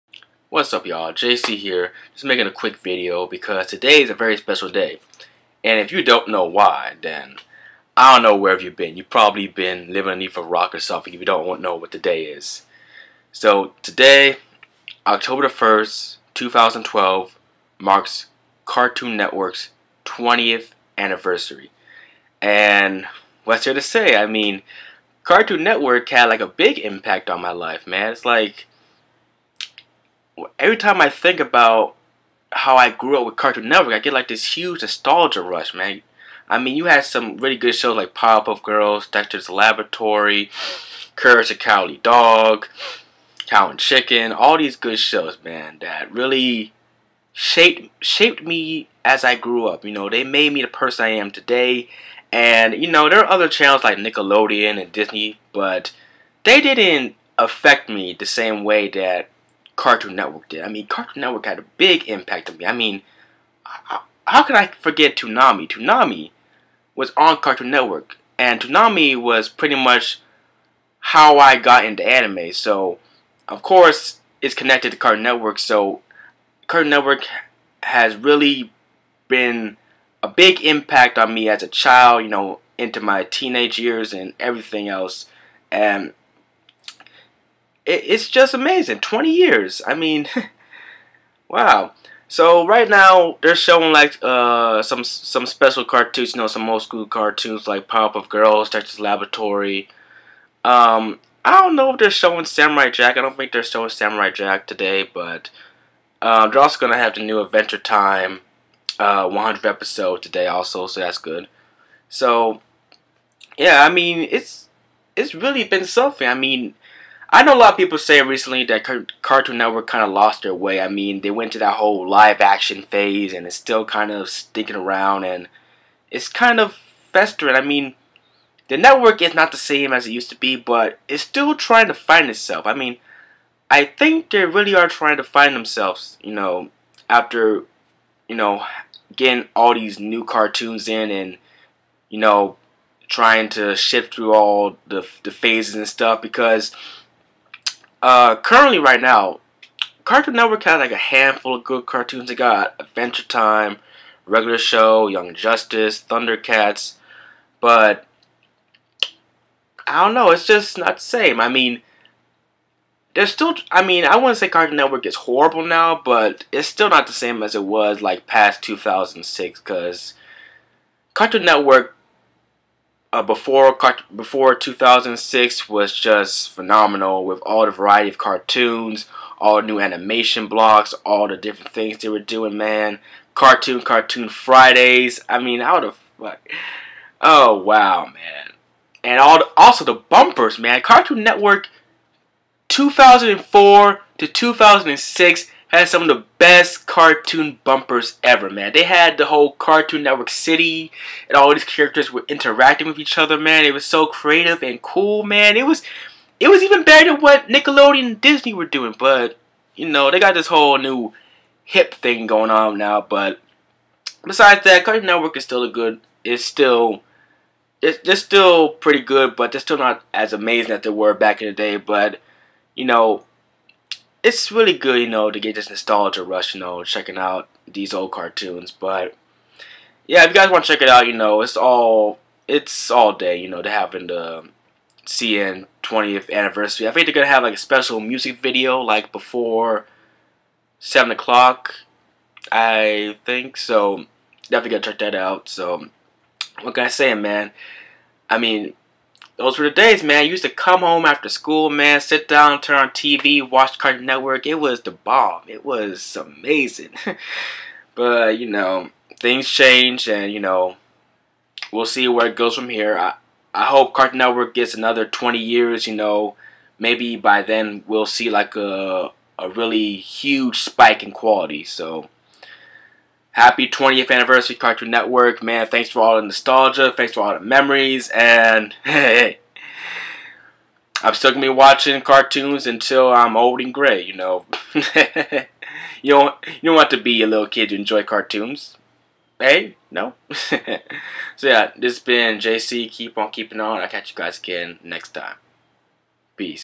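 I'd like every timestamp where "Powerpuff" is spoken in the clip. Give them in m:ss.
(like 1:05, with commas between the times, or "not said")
0:38, 1:37.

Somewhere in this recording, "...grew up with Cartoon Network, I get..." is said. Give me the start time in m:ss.
0:32.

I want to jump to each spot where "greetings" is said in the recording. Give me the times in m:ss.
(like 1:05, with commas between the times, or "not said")
not said.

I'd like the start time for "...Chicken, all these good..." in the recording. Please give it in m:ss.
0:43.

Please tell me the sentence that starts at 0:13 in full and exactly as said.
So today, October the 1st, 2012, marks Cartoon Network's 20th anniversary.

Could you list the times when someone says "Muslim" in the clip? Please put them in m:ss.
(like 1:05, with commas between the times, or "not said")
not said.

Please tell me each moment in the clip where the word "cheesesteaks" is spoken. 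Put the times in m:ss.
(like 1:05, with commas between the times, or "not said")
not said.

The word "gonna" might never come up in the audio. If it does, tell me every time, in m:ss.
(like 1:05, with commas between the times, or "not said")
1:46, 3:57.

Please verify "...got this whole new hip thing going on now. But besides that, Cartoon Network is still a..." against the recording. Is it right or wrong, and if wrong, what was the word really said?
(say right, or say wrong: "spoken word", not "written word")
right.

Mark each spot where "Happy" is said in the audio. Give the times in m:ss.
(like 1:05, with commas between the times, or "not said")
4:33.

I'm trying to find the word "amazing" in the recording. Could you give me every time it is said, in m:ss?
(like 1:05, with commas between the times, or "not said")
1:28, 3:40, 4:16.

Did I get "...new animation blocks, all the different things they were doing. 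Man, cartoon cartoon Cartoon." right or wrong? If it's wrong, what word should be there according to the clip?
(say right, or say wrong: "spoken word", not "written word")
wrong: "Fridays", not "Cartoon".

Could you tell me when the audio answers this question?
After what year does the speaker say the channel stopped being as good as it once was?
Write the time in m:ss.
2:48.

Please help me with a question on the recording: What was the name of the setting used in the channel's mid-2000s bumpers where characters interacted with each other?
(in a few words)
Cartoon Network City.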